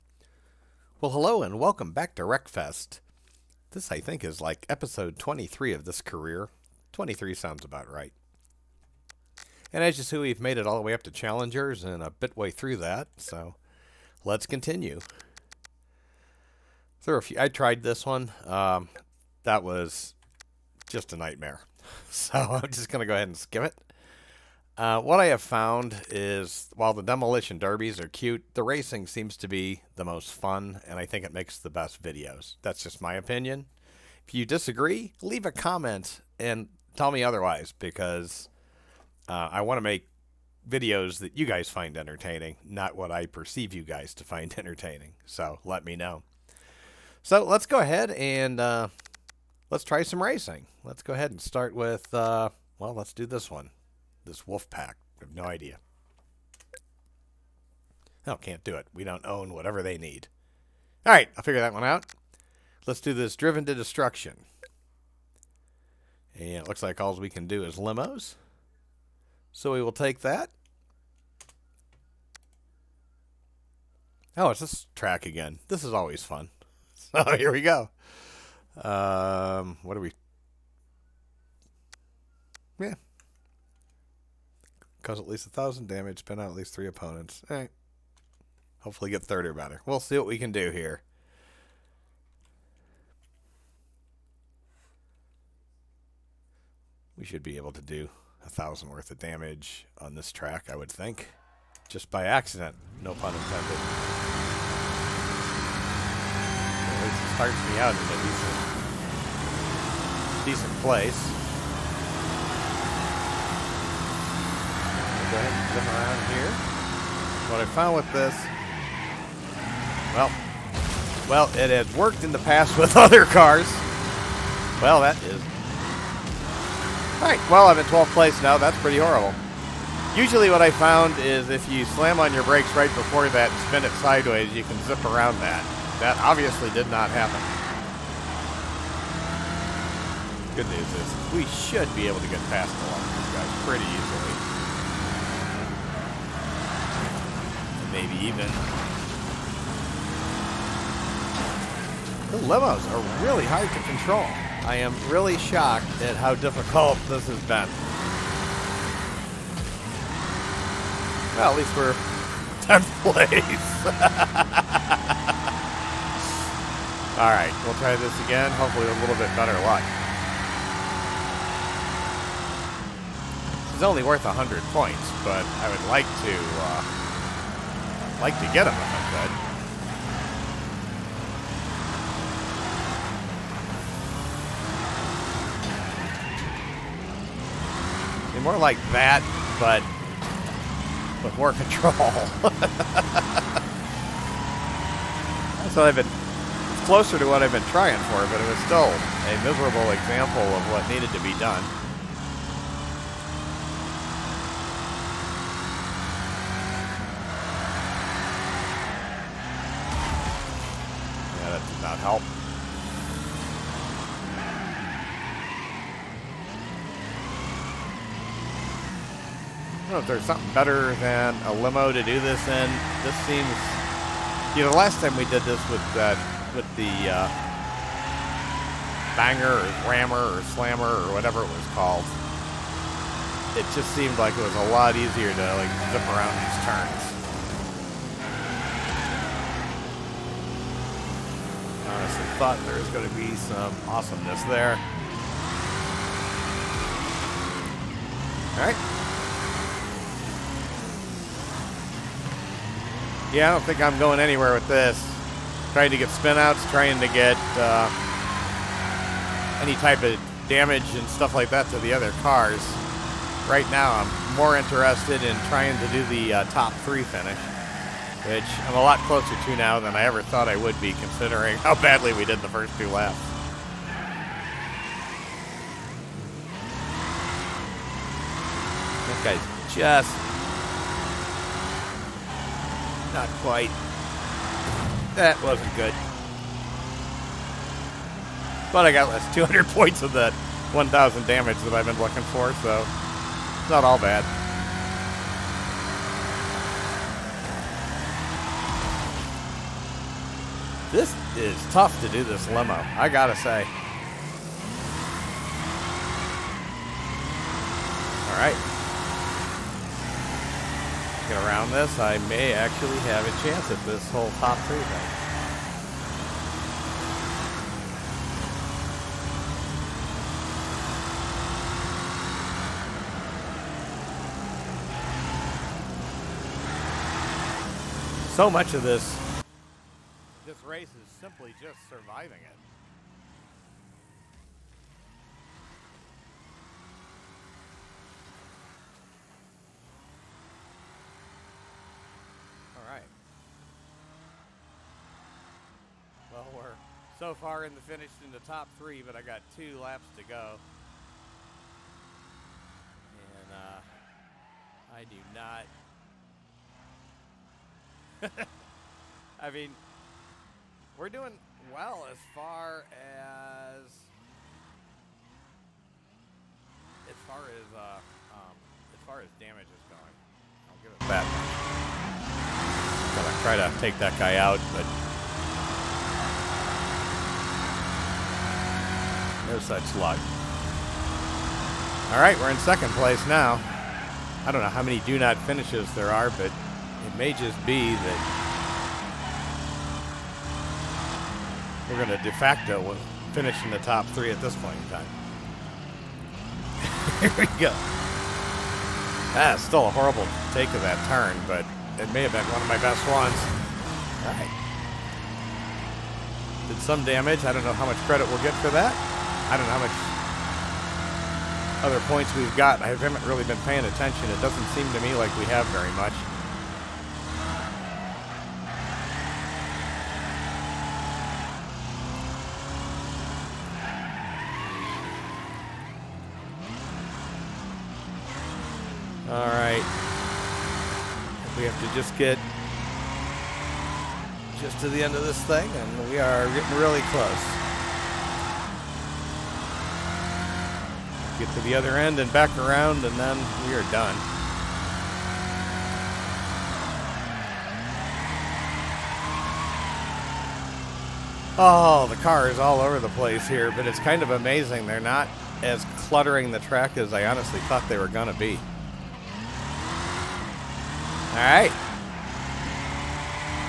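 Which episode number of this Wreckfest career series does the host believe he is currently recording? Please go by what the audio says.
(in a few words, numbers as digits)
23.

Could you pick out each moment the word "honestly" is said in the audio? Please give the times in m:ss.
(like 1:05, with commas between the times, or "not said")
4:01, 7:37.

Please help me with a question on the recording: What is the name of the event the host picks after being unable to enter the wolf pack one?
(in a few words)
Driven to destruction.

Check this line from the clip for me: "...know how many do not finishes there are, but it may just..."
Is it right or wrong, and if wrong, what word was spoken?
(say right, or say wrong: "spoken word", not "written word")
right.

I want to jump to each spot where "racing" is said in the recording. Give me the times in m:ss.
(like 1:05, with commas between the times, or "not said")
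0:28, 0:50.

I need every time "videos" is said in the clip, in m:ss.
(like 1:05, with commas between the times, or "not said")
0:32, 0:40.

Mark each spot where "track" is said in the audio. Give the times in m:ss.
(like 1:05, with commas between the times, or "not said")
1:14, 1:40, 7:36.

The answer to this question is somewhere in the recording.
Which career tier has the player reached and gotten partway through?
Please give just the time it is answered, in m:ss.
0:11.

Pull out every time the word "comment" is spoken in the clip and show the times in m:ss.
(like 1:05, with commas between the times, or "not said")
0:35.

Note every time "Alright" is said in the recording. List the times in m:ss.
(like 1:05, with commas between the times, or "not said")
4:08, 5:08.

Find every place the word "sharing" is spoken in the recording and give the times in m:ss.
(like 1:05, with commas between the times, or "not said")
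not said.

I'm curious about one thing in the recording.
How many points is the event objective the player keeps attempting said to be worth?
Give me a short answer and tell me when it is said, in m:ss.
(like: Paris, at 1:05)
100, at 2:54.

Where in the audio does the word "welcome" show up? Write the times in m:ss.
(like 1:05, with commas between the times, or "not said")
0:01.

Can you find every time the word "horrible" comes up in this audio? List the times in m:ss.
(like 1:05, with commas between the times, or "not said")
2:08, 6:39.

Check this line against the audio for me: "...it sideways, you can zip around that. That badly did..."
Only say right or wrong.
wrong.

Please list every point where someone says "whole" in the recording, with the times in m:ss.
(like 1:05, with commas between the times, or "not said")
5:14.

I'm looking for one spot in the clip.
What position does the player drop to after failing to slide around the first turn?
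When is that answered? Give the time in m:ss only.
2:07.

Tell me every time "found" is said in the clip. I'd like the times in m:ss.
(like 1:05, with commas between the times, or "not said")
0:25, 1:57, 2:10.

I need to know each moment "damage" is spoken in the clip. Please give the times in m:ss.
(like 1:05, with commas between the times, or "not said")
1:25, 1:39, 4:20, 4:51, 6:09, 6:47.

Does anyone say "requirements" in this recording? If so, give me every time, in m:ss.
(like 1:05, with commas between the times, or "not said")
not said.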